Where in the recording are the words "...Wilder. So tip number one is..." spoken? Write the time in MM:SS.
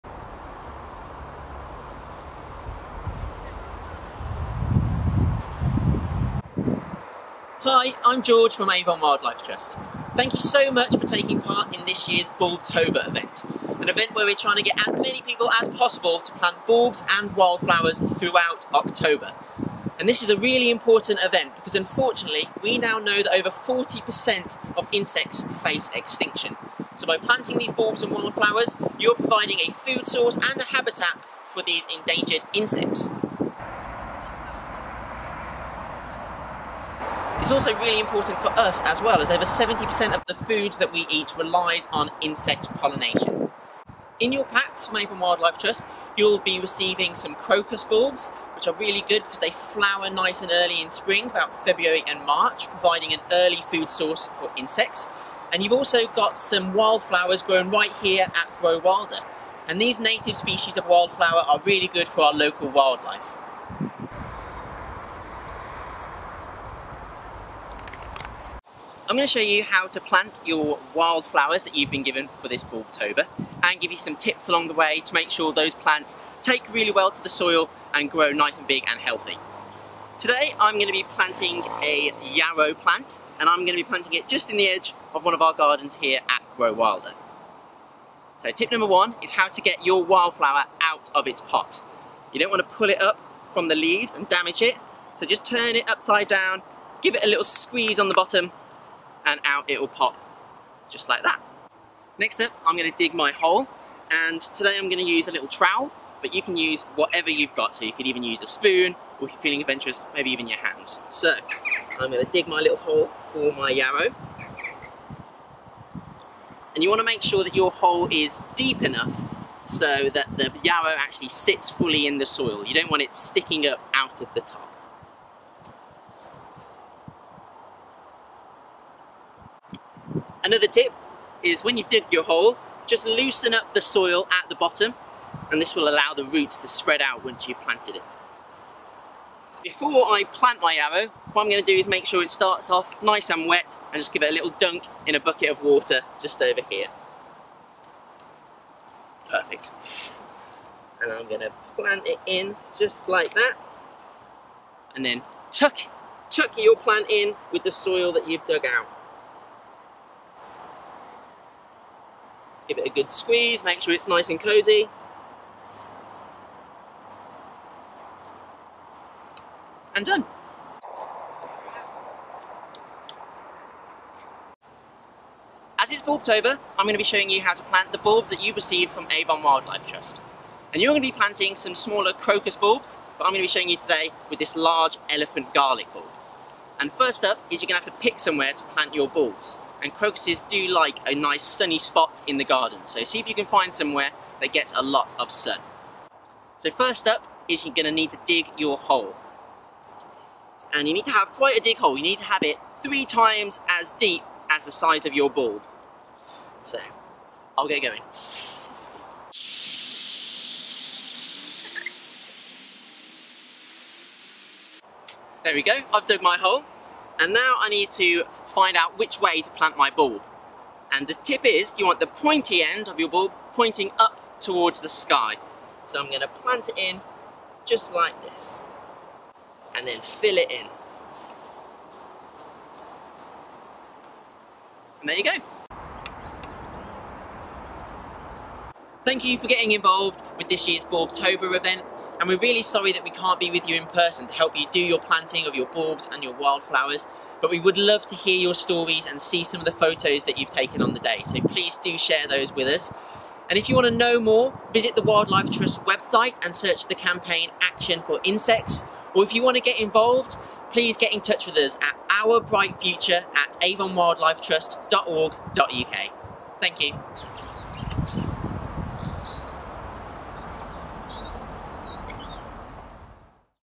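01:26.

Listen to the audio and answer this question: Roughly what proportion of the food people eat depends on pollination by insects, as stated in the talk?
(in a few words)
over 70%.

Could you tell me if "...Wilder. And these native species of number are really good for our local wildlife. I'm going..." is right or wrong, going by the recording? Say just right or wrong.
wrong.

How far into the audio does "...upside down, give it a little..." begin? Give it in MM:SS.
01:35.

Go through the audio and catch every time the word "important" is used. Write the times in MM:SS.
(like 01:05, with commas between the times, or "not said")
00:20, 00:37.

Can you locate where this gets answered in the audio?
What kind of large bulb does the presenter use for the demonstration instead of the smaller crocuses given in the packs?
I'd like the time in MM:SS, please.
03:05.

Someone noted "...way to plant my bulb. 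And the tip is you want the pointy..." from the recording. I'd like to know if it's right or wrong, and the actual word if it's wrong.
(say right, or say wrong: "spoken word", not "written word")
right.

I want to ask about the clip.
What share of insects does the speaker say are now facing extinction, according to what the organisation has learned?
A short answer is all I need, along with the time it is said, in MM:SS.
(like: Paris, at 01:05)
over 40%, at 00:23.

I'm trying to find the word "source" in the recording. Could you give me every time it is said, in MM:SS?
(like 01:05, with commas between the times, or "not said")
00:30, 00:53.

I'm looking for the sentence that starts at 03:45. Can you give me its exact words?
So I'm going to plant it in just like this and then fill it in.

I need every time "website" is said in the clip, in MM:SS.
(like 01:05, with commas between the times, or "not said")
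04:15.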